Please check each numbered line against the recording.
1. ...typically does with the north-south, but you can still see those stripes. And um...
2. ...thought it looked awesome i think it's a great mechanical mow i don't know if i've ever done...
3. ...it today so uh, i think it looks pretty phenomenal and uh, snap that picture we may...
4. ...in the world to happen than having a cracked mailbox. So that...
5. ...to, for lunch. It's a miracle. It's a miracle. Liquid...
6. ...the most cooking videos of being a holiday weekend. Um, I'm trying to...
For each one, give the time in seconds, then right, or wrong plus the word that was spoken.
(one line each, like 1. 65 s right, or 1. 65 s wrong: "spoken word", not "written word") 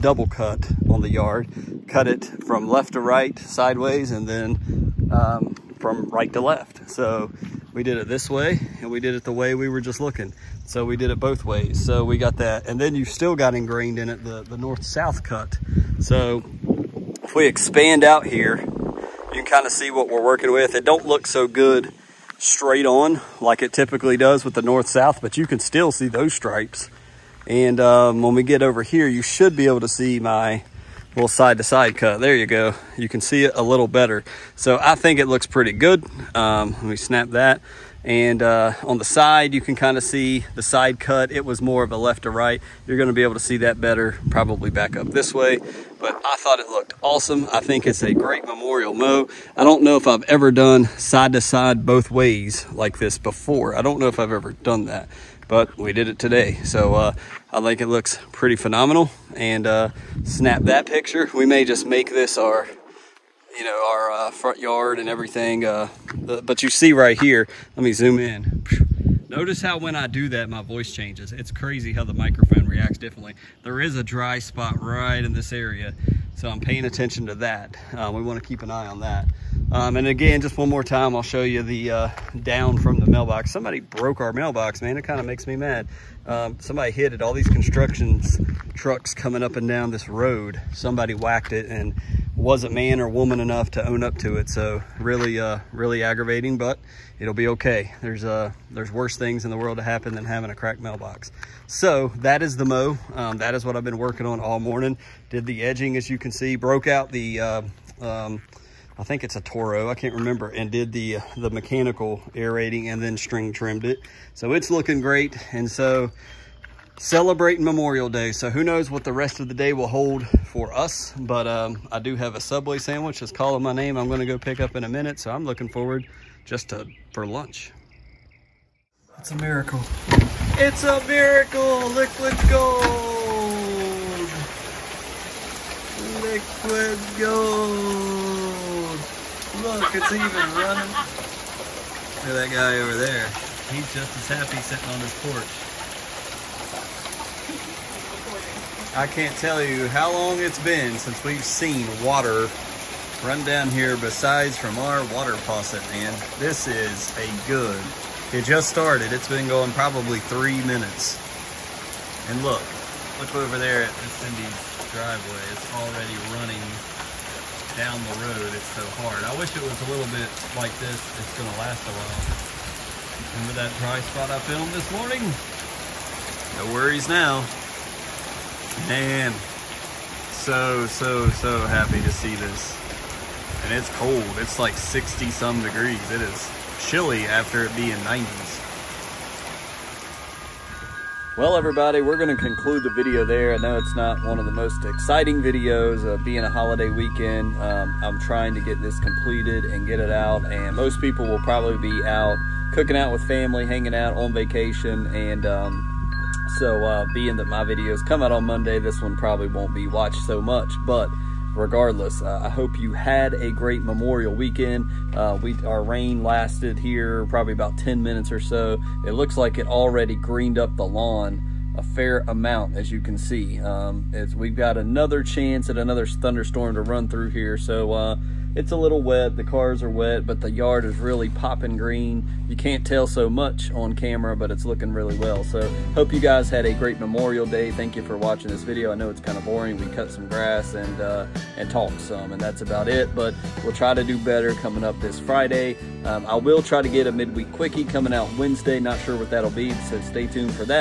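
1. 23 s right
2. 46 s wrong: "memorial", not "mechanical"
3. 56 s right
4. 99 s right
5. 126 s right
6. 194 s wrong: "exciting", not "cooking".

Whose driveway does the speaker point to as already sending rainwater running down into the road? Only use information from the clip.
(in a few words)
Cindy's.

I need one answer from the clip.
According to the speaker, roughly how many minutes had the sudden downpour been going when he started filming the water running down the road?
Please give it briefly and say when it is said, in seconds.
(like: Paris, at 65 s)
3, at 160 s.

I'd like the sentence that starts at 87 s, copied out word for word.
All these construction trucks coming up and down this road.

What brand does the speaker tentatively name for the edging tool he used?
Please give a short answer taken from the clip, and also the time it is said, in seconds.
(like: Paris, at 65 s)
Toro, at 109 s.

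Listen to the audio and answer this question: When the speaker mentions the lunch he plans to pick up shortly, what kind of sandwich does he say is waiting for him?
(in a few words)
Subway.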